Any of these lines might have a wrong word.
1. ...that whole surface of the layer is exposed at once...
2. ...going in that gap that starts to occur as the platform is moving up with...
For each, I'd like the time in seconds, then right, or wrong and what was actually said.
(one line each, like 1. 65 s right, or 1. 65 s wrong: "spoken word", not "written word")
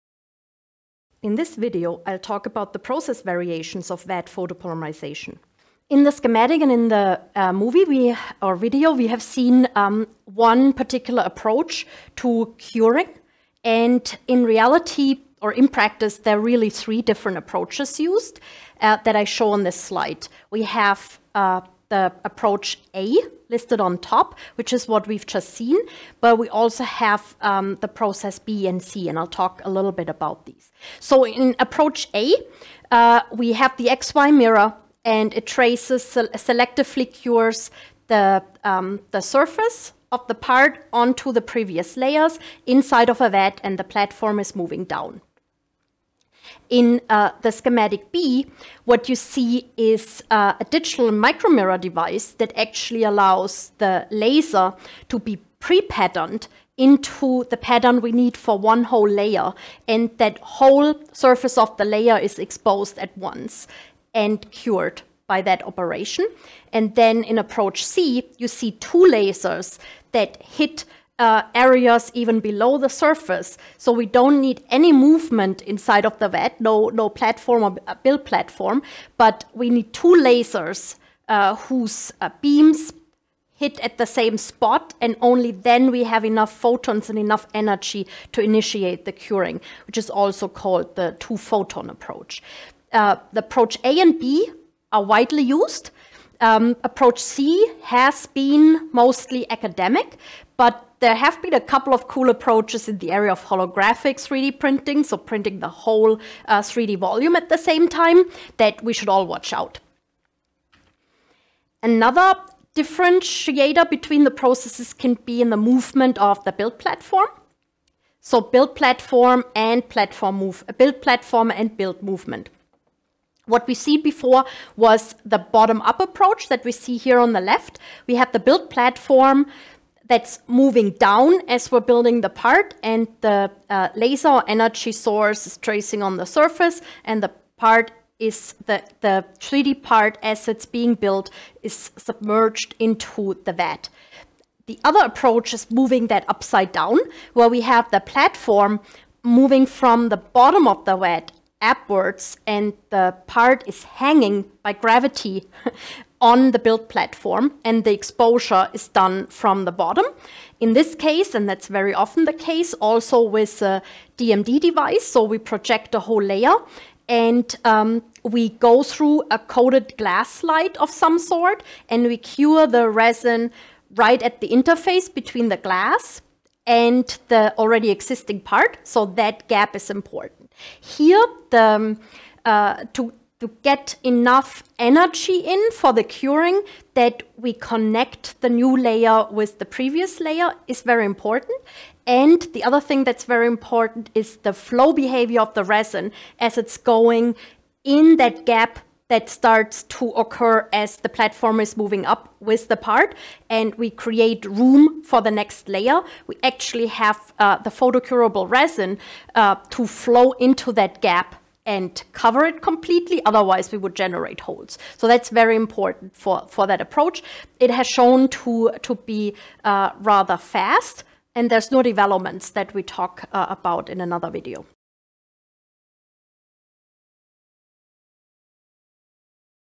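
1. 60 s right
2. 196 s right.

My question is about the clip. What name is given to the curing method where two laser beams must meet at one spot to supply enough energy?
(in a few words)
two-photon approach.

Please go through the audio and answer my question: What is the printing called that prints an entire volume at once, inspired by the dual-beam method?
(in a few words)
holographic 3D printing.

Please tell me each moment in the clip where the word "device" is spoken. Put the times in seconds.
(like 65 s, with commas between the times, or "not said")
51 s, 164 s.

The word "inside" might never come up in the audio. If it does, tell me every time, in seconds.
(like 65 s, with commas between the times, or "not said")
42 s, 75 s.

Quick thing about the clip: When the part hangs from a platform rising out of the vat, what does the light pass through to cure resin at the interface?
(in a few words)
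a coated glass slide.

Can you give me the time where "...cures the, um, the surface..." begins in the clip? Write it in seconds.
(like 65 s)
37 s.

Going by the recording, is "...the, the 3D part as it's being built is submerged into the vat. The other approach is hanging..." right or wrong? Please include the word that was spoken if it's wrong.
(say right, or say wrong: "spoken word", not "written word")
wrong: "moving", not "hanging".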